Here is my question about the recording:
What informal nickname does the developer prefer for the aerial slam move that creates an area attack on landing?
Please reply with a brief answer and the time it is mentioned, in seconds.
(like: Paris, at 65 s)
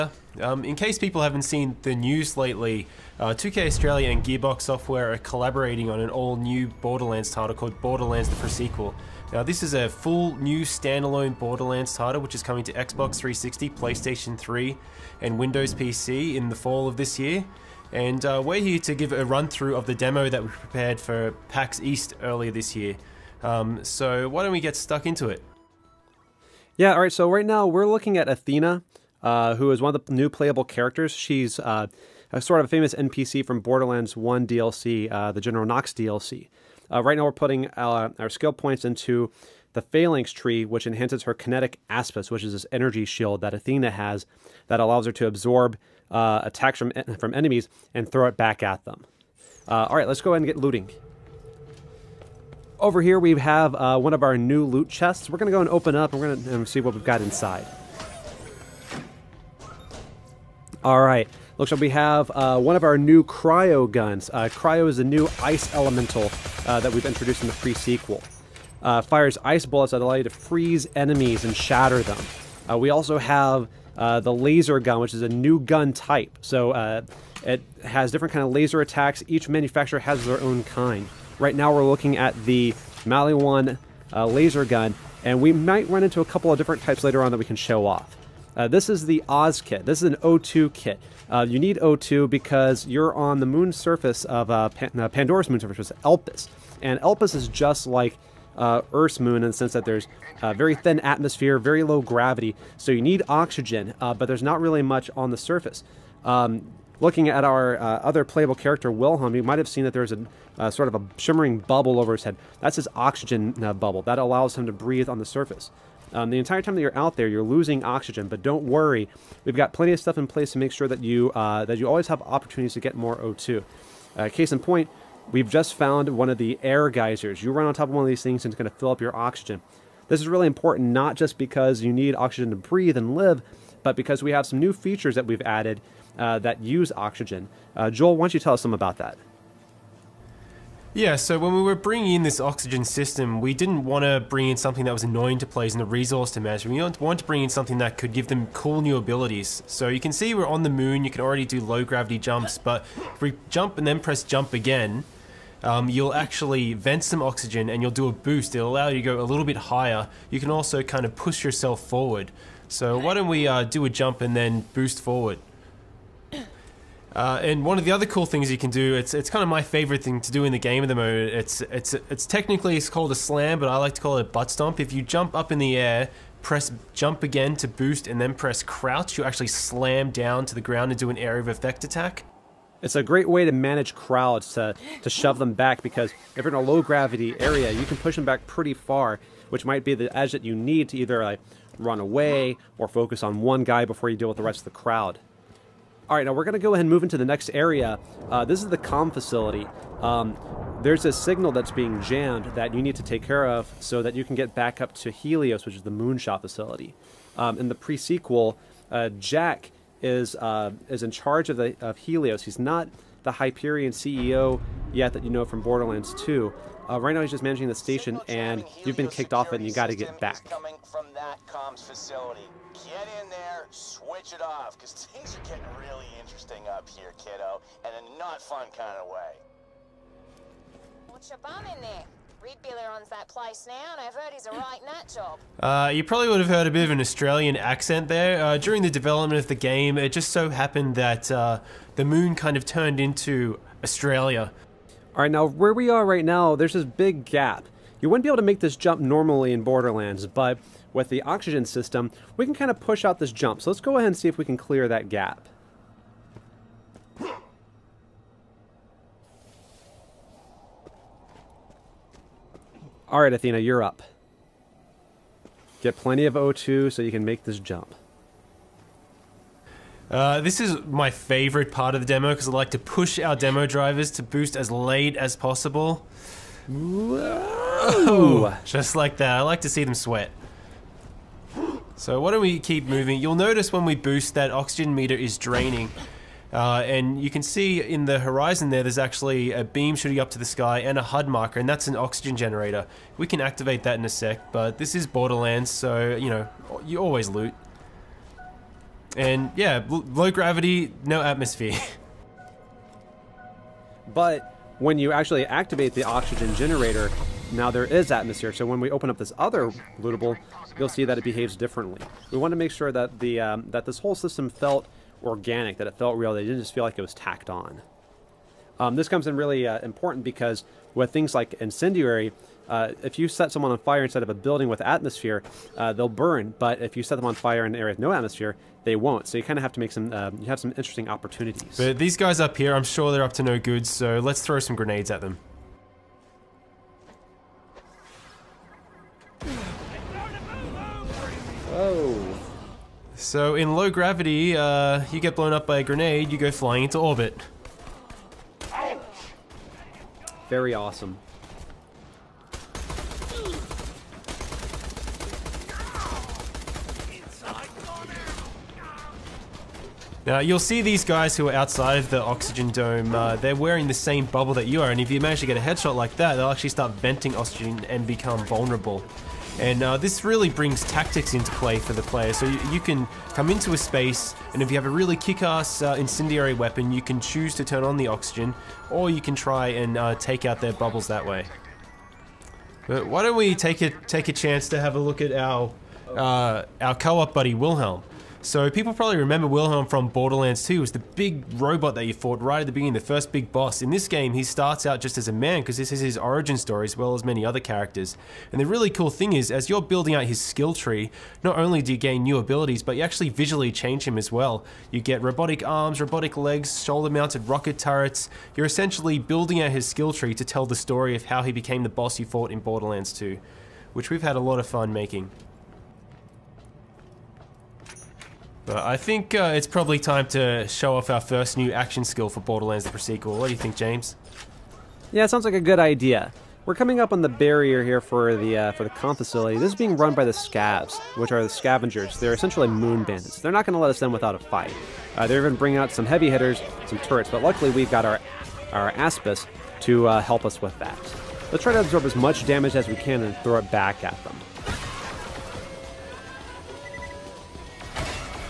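butt stomp, at 174 s.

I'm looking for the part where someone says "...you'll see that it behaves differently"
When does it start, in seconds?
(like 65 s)
310 s.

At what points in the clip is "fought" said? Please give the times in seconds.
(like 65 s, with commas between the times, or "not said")
392 s, 412 s.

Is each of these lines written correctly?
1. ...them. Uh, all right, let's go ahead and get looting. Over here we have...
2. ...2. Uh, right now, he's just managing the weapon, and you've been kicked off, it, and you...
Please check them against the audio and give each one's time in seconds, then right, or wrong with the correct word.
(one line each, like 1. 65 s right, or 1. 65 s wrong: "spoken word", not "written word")
1. 48 s right
2. 216 s wrong: "station", not "weapon".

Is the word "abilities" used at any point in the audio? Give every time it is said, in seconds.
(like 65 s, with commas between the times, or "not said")
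148 s, 402 s.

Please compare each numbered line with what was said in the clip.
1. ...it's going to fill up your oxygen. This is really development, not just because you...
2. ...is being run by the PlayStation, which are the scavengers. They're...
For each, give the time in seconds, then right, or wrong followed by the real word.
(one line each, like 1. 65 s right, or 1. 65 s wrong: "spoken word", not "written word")
1. 128 s wrong: "important", not "development"
2. 429 s wrong: "Scavs", not "PlayStation".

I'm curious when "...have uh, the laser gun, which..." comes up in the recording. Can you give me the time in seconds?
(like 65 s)
73 s.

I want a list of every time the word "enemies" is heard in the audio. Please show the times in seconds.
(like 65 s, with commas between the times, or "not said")
47 s, 70 s.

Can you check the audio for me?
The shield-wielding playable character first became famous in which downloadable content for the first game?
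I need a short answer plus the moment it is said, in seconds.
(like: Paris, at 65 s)
General Knox DLC, at 35 s.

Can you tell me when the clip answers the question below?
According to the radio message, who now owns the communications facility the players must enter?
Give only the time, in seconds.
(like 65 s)
232 s.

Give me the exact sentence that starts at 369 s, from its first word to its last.
And uh, this really brings tactics into play for the player.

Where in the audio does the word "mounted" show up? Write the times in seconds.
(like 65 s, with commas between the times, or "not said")
406 s.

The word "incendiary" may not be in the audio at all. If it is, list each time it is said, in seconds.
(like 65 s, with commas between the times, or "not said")
321 s, 375 s.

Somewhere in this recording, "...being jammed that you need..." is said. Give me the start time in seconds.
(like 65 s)
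201 s.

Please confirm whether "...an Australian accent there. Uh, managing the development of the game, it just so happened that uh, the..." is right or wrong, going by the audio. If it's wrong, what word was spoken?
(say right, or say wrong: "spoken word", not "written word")
wrong: "during", not "managing".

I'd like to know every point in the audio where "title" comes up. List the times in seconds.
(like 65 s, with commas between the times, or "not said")
7 s, 11 s.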